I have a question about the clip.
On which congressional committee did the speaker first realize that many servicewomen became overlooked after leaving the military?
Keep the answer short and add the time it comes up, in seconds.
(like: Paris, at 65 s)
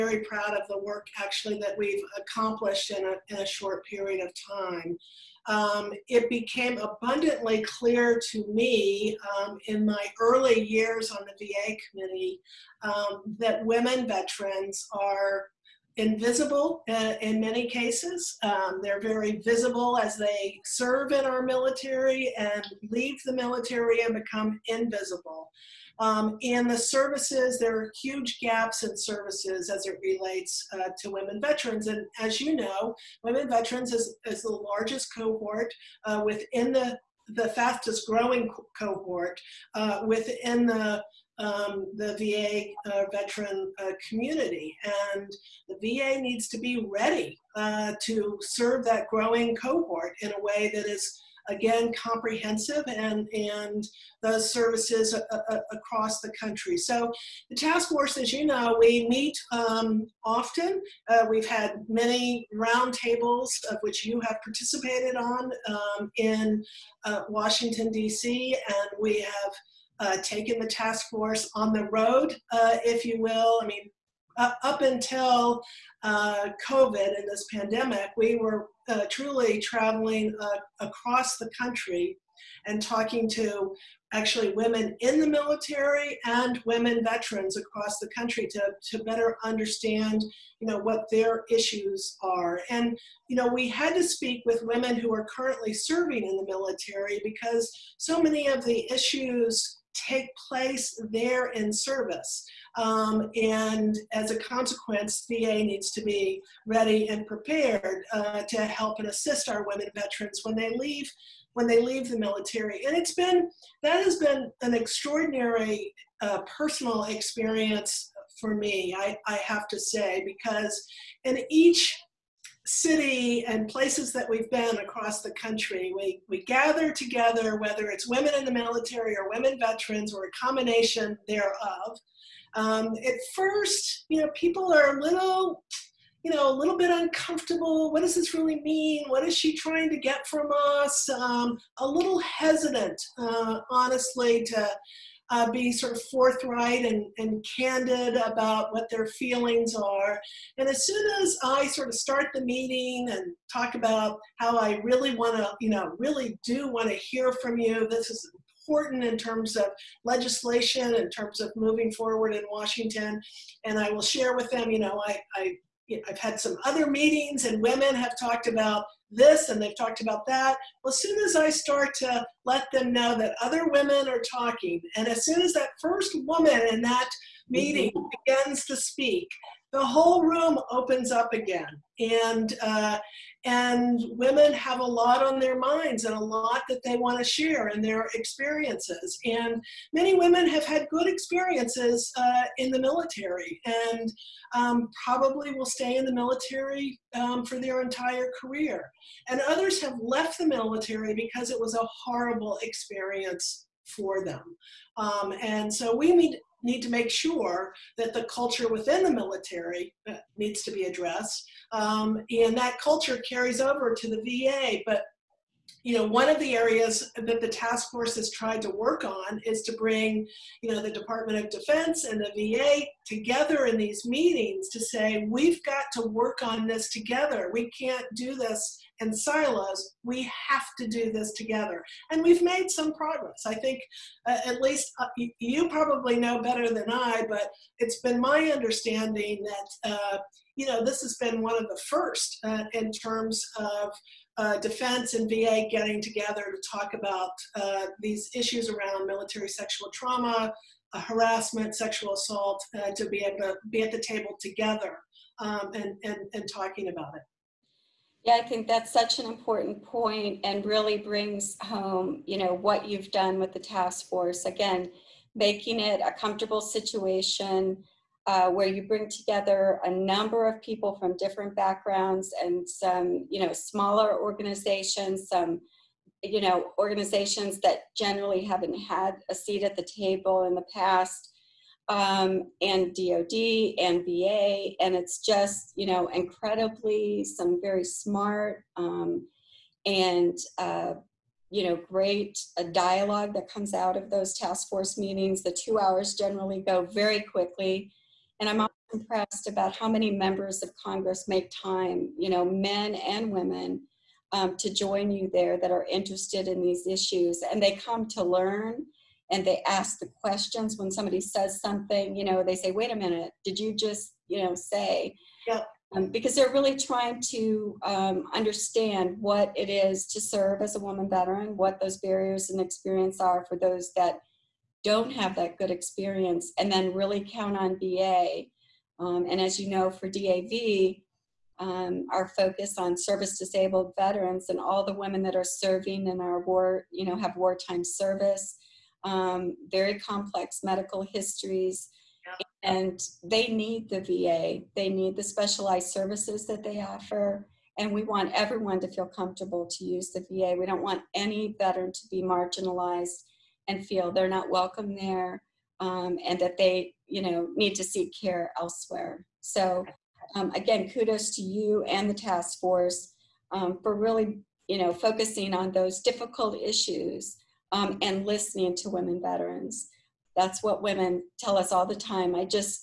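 VA committee, at 11 s.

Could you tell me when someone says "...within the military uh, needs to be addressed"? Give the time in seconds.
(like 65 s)
208 s.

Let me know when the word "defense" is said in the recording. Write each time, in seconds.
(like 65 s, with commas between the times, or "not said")
221 s, 244 s.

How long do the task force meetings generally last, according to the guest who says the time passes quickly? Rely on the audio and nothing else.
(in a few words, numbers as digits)
2 hours.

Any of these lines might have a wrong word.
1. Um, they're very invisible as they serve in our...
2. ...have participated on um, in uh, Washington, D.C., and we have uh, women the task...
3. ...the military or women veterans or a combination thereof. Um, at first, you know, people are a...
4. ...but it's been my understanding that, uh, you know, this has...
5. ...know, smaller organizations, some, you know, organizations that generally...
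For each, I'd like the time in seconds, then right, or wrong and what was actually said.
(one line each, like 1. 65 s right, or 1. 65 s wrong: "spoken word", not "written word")
1. 18 s wrong: "visible", not "invisible"
2. 64 s wrong: "taken", not "women"
3. 128 s right
4. 237 s right
5. 273 s right.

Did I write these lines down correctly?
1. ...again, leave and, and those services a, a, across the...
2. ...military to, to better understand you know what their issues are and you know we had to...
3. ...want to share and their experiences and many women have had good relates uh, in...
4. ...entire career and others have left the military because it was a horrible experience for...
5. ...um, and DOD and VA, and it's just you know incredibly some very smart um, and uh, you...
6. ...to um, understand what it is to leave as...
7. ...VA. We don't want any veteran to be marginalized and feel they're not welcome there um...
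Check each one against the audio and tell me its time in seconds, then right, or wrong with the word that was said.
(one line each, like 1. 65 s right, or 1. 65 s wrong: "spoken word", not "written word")
1. 51 s wrong: "comprehensive", not "leave"
2. 88 s wrong: "country", not "military"
3. 186 s wrong: "experiences", not "relates"
4. 197 s right
5. 281 s right
6. 317 s wrong: "serve", not "leave"
7. 350 s right.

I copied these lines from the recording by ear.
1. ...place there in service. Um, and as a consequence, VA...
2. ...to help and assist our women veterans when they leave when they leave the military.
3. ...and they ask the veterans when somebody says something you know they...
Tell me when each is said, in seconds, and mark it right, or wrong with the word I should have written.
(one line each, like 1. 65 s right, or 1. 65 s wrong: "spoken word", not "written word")
1. 100 s right
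2. 108 s right
3. 309 s wrong: "questions", not "veterans".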